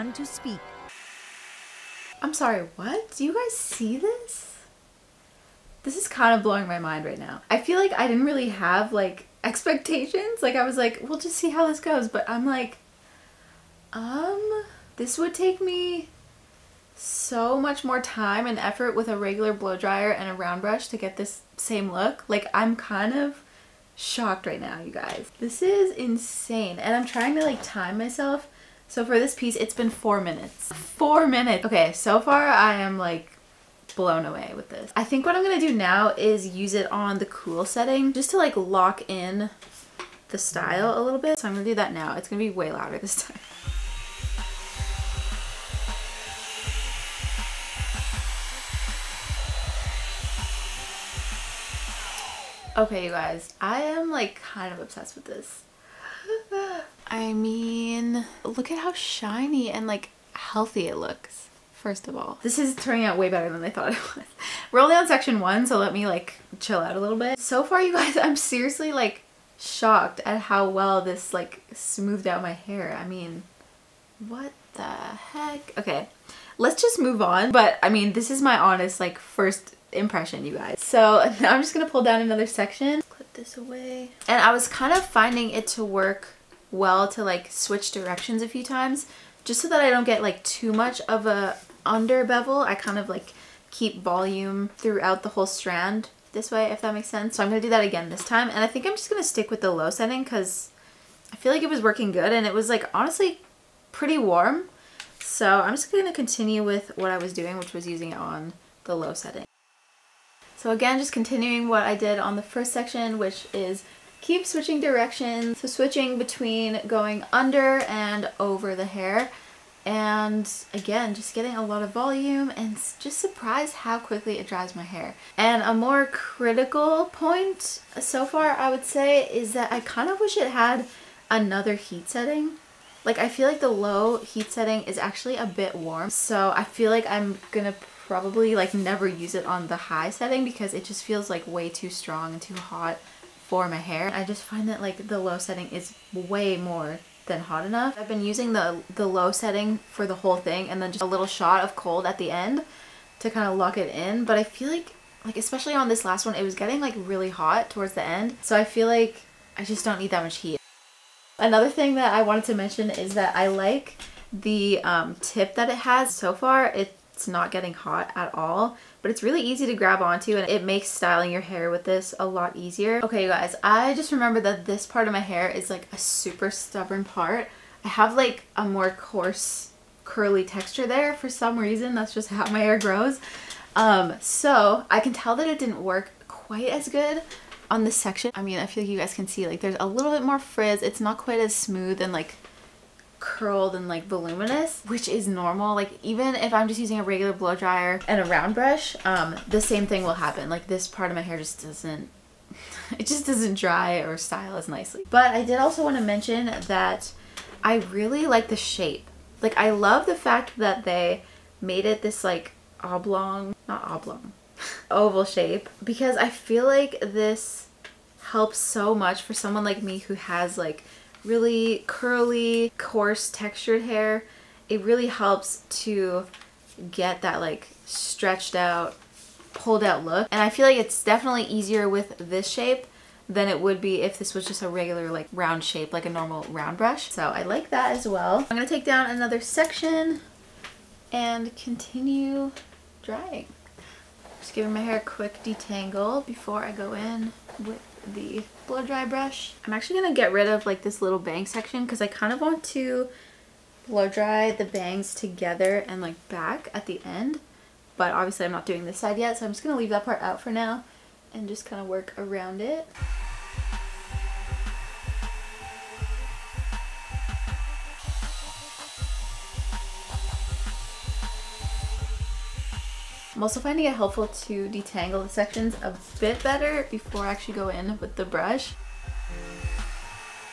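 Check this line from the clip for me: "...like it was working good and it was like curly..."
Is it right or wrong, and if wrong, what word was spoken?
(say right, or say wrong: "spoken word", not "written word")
wrong: "honestly", not "curly".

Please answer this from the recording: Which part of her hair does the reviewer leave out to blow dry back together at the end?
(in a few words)
bang section.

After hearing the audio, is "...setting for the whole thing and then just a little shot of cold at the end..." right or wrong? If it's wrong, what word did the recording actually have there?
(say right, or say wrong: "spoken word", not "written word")
right.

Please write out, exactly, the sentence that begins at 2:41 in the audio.
Another thing that I wanted to mention is that I like the um, tip that it has.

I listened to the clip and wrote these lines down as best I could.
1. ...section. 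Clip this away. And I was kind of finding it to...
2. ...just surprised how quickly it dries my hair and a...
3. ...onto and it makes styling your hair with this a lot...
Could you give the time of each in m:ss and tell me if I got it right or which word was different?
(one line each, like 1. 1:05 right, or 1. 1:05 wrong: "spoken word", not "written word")
1. 1:22 right
2. 2:02 right
3. 2:50 right.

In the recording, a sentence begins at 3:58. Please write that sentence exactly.
I'm gonna take down another section and continue drying.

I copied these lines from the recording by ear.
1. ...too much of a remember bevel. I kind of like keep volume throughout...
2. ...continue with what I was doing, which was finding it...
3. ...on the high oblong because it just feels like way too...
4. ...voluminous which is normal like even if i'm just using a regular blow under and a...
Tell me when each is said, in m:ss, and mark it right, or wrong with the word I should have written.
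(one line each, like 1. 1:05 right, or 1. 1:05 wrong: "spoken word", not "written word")
1. 1:30 wrong: "under", not "remember"
2. 1:46 wrong: "using", not "finding"
3. 2:19 wrong: "setting", not "oblong"
4. 3:14 wrong: "dryer", not "under".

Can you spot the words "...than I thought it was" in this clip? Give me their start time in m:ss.
1:03.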